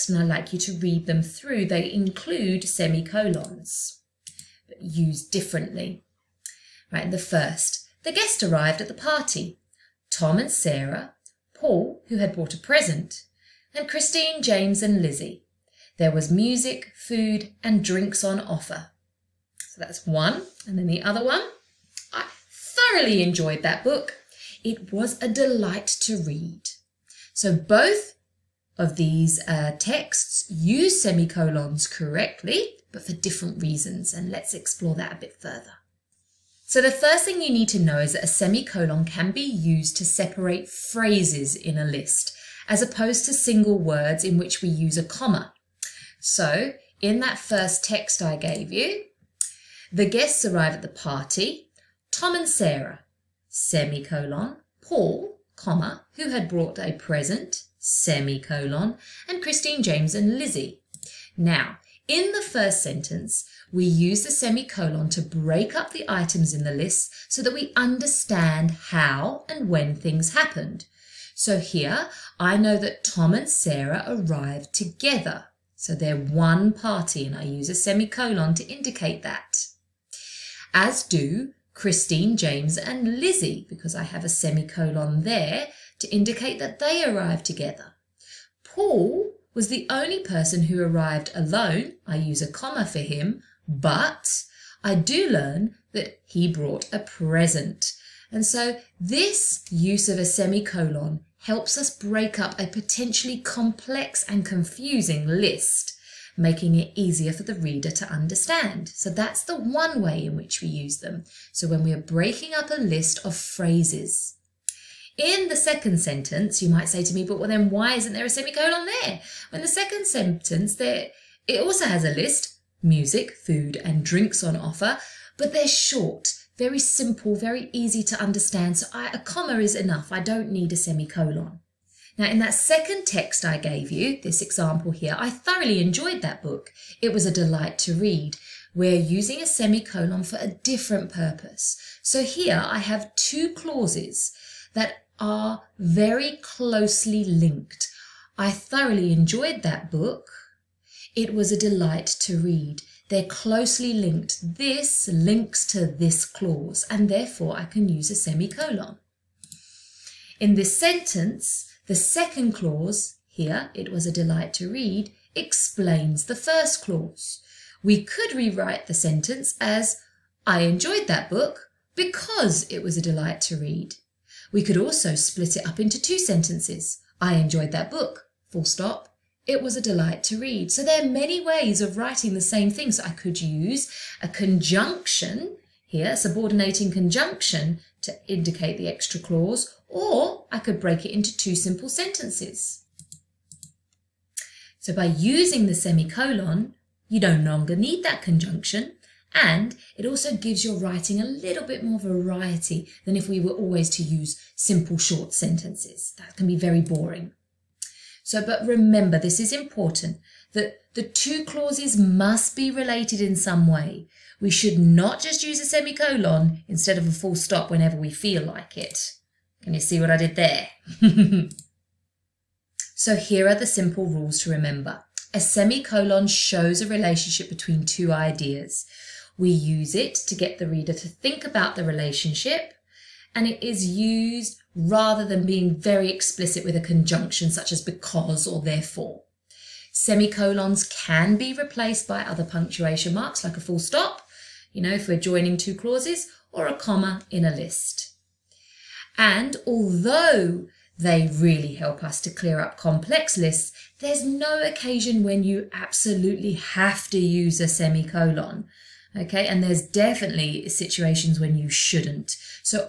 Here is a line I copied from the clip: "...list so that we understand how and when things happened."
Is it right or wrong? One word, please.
right.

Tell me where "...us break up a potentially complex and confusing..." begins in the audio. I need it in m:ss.
1:41.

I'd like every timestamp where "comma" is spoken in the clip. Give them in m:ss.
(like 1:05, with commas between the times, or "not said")
0:45, 0:55, 1:32, 2:09, 4:06.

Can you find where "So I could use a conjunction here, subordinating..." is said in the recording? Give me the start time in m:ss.
3:02.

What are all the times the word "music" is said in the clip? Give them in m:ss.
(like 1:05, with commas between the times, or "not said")
0:16, 2:02.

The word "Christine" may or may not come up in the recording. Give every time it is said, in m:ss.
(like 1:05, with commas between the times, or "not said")
0:13, 0:59, 1:21.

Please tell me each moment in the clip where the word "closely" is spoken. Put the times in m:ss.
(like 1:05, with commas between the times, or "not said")
2:26, 2:33.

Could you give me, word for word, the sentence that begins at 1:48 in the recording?
So that's the one way in which we use them.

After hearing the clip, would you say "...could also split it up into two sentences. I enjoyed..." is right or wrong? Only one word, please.
right.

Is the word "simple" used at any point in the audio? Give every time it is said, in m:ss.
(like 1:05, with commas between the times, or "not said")
2:06, 3:11, 3:24, 3:43.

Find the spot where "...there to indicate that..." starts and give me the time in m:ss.
1:25.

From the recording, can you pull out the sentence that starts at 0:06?
Right, the first, the guest arrived at the party.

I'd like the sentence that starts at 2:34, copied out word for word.
This links to this clause, and therefore I can use a semicolon.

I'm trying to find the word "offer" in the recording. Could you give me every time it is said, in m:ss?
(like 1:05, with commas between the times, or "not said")
0:18, 2:04.